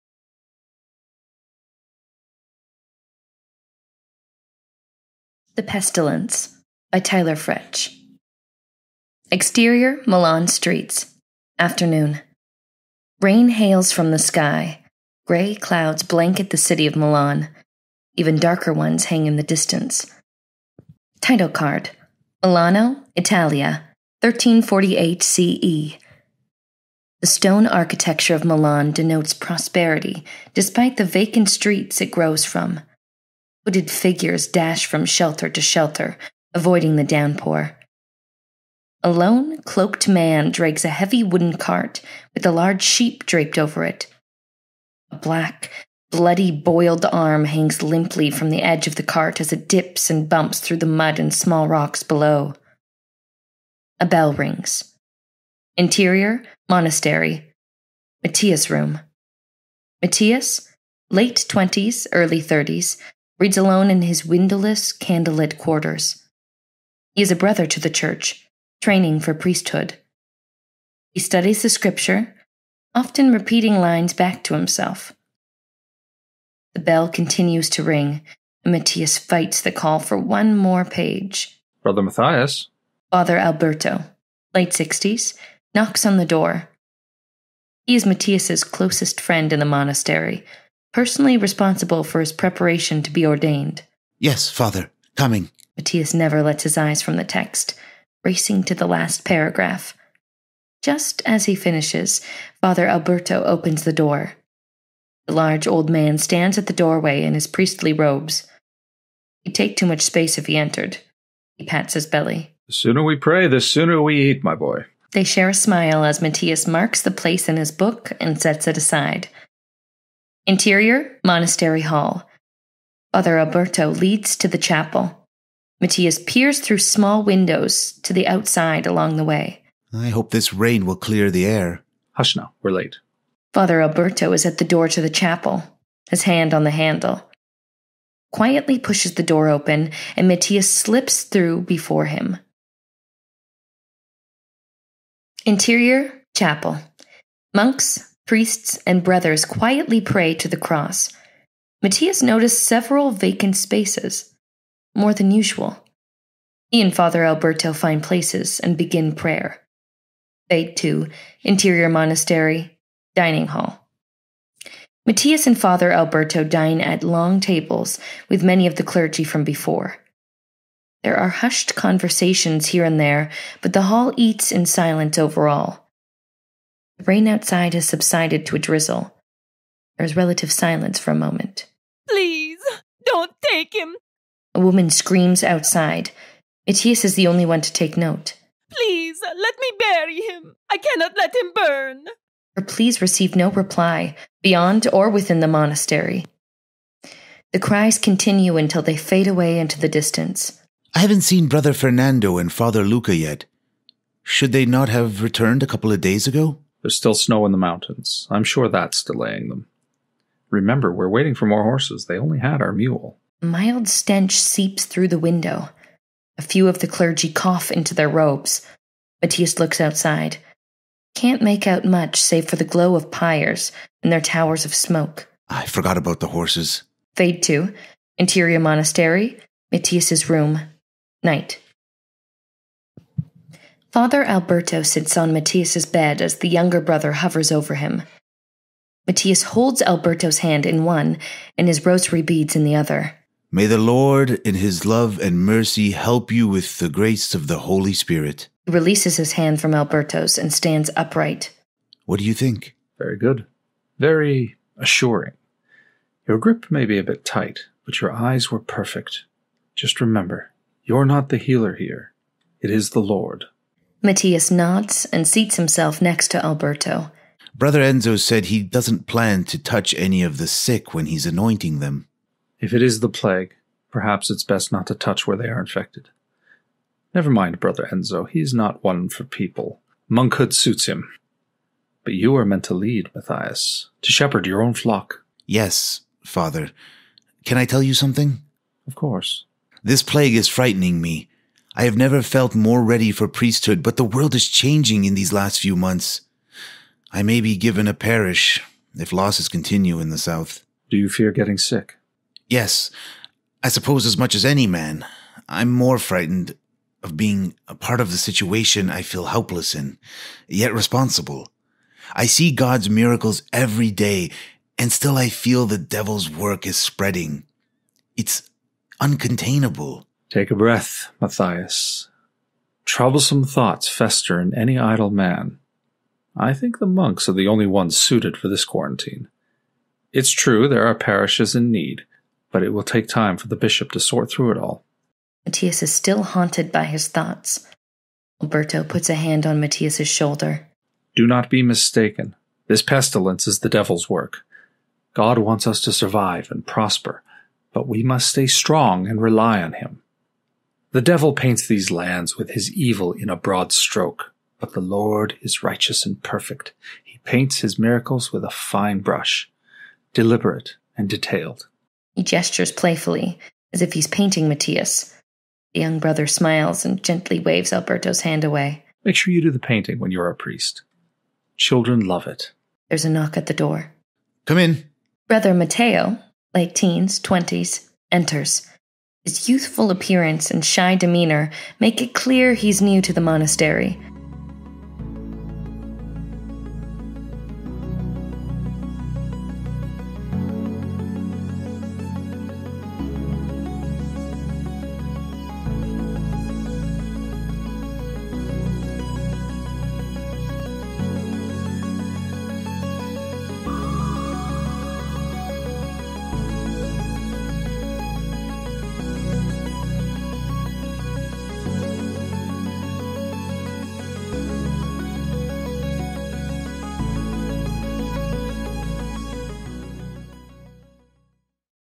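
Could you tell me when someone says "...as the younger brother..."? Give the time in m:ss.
3:56.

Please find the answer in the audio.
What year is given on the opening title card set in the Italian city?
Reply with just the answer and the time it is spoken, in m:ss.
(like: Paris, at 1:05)
1348, at 0:24.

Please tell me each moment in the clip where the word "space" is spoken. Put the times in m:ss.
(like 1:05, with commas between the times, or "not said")
1:50, 2:33.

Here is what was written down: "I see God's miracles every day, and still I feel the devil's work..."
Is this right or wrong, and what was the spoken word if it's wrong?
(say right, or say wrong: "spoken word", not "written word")
right.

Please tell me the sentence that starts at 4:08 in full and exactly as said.
He releases his hand from Alberto's and stands upright.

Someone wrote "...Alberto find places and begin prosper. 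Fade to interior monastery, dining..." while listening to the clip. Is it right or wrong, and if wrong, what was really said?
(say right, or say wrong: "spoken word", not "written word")
wrong: "prayer", not "prosper".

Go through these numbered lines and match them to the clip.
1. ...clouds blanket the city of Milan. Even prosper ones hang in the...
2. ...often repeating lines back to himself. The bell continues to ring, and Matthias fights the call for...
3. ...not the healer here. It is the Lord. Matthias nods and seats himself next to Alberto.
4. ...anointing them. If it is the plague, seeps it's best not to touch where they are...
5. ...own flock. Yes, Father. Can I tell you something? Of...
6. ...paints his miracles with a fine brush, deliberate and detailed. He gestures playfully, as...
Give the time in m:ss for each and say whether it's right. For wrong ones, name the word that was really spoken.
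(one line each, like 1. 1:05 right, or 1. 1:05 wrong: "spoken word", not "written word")
1. 0:15 wrong: "darker", not "prosper"
2. 1:12 right
3. 4:21 right
4. 4:31 wrong: "perhaps", not "seeps"
5. 4:44 right
6. 5:57 right.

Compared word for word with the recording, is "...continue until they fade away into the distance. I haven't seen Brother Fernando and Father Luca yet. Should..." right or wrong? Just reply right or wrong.
right.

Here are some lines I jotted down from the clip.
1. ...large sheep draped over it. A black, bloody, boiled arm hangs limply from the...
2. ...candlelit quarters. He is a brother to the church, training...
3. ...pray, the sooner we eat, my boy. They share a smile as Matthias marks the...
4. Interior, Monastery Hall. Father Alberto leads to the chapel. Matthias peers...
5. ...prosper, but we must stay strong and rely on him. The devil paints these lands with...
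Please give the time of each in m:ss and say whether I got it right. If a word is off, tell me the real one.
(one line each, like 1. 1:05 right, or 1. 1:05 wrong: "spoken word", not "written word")
1. 0:42 right
2. 1:04 right
3. 1:53 right
4. 2:00 right
5. 5:46 right.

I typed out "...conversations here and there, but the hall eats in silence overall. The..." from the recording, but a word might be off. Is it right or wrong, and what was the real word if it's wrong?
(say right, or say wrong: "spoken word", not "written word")
right.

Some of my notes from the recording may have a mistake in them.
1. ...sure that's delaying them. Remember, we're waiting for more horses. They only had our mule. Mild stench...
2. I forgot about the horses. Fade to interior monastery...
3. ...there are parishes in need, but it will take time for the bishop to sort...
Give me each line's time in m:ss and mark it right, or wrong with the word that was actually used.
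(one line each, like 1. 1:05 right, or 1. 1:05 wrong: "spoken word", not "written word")
1. 3:28 right
2. 3:45 right
3. 5:30 right.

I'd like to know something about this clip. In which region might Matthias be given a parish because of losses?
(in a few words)
The South.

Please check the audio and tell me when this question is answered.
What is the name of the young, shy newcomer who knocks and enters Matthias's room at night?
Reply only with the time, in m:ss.
6:15.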